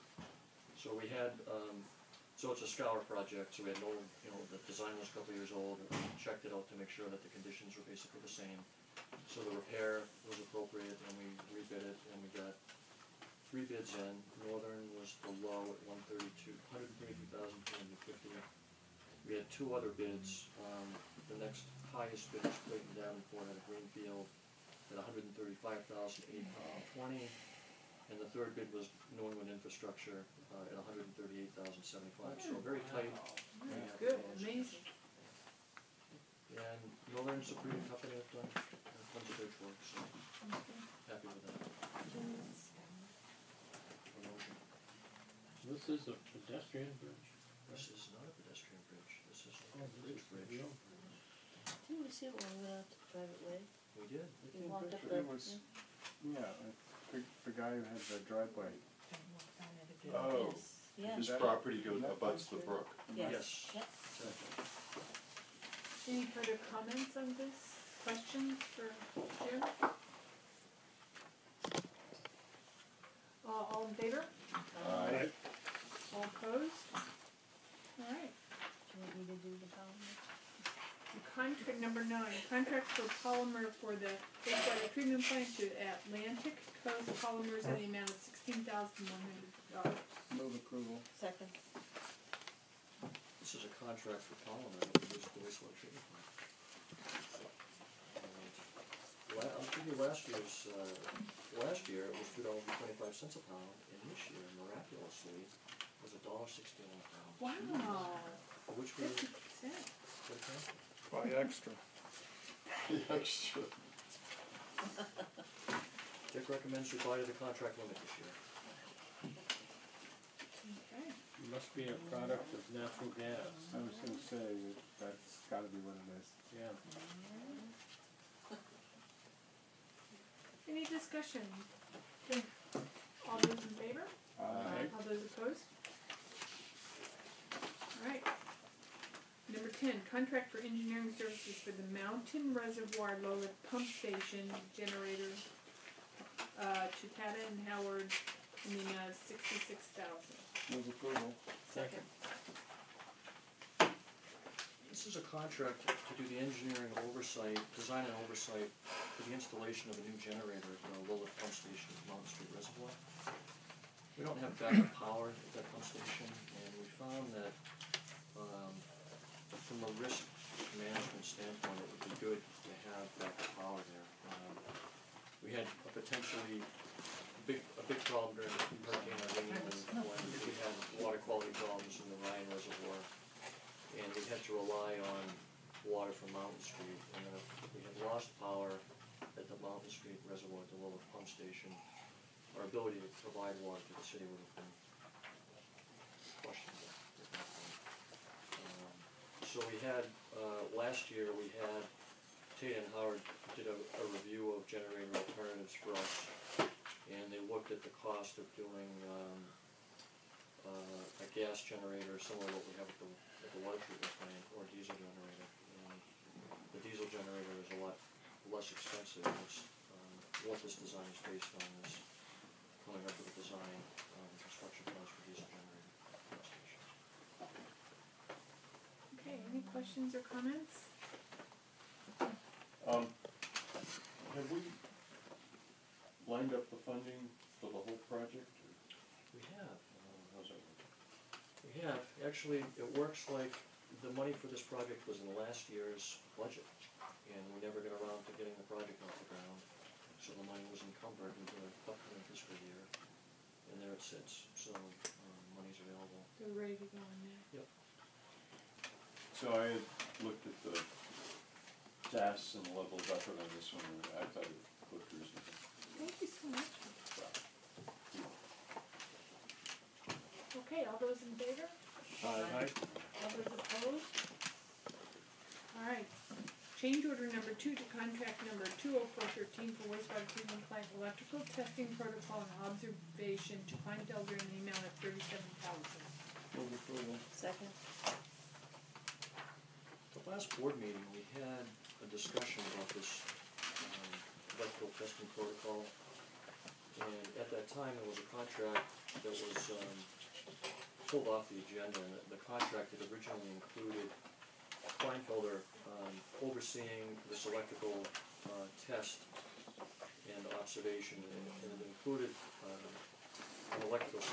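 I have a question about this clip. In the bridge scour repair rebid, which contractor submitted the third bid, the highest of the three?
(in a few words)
New England Infrastructure.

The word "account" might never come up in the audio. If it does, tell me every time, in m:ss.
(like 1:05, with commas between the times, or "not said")
1:50.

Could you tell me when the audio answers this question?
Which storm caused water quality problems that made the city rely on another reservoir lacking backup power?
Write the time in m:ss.
2:58.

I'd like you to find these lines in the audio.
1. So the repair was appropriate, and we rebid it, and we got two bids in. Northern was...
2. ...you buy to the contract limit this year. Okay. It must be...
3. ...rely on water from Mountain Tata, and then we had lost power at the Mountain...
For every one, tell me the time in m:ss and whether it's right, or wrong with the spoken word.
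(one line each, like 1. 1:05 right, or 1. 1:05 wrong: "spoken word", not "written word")
1. 0:09 wrong: "three", not "two"
2. 1:56 right
3. 3:04 wrong: "Street", not "Tata".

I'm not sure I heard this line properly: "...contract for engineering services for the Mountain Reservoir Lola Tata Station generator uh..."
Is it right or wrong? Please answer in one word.
wrong.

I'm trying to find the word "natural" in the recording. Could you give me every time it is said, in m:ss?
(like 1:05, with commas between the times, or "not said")
2:02.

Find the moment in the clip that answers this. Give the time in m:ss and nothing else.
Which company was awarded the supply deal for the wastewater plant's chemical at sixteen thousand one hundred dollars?
1:25.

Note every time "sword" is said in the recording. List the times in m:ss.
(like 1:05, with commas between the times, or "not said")
not said.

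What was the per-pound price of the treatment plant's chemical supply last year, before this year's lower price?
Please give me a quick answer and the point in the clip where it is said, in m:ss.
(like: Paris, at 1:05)
$2.25, at 1:42.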